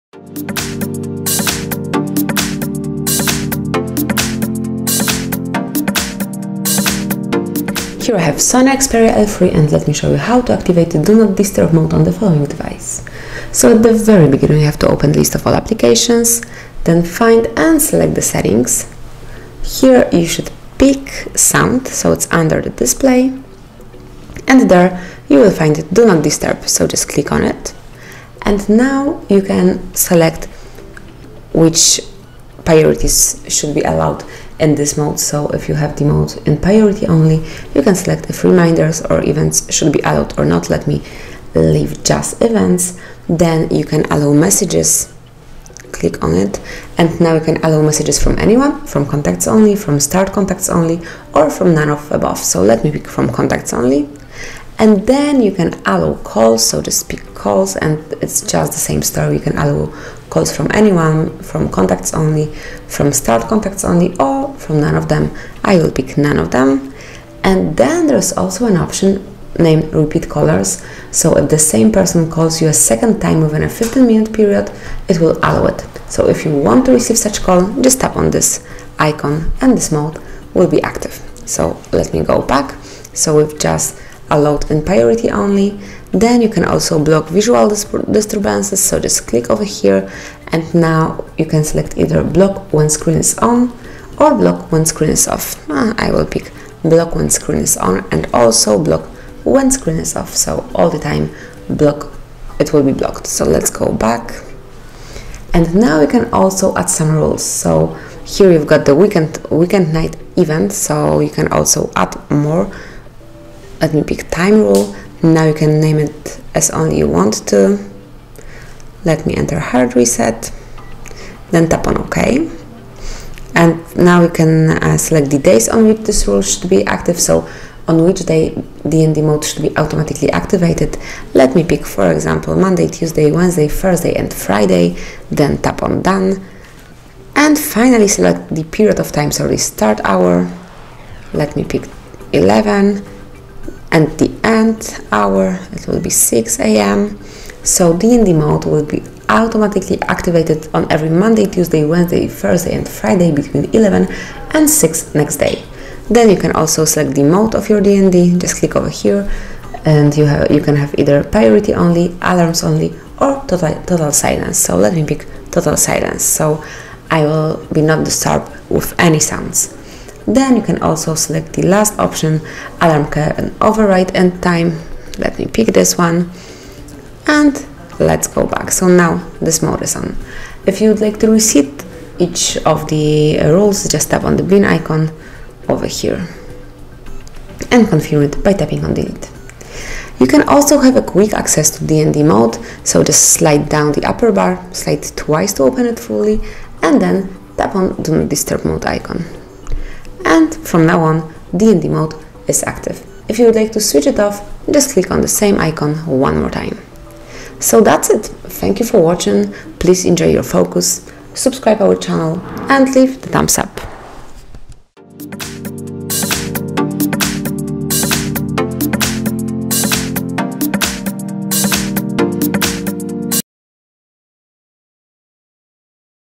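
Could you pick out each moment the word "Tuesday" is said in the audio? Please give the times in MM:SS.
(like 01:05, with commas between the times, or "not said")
02:12, 02:31.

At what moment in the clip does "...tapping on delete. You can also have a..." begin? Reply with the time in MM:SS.
03:08.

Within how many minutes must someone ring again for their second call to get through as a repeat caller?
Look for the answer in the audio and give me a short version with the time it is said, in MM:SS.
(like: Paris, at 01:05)
15, at 01:13.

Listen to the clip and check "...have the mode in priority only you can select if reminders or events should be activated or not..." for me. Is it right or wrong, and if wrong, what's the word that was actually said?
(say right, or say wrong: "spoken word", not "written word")
wrong: "allowed", not "activated".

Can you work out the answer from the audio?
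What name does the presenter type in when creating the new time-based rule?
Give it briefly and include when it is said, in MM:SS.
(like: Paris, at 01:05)
hard reset, at 01:59.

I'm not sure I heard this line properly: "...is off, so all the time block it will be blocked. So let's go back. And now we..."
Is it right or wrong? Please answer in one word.
right.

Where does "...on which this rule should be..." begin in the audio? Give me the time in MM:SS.
02:05.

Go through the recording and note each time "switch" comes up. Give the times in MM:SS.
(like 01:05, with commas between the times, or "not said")
03:23.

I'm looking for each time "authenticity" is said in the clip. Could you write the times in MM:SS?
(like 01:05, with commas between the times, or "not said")
not said.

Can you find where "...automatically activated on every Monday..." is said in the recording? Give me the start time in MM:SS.
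02:29.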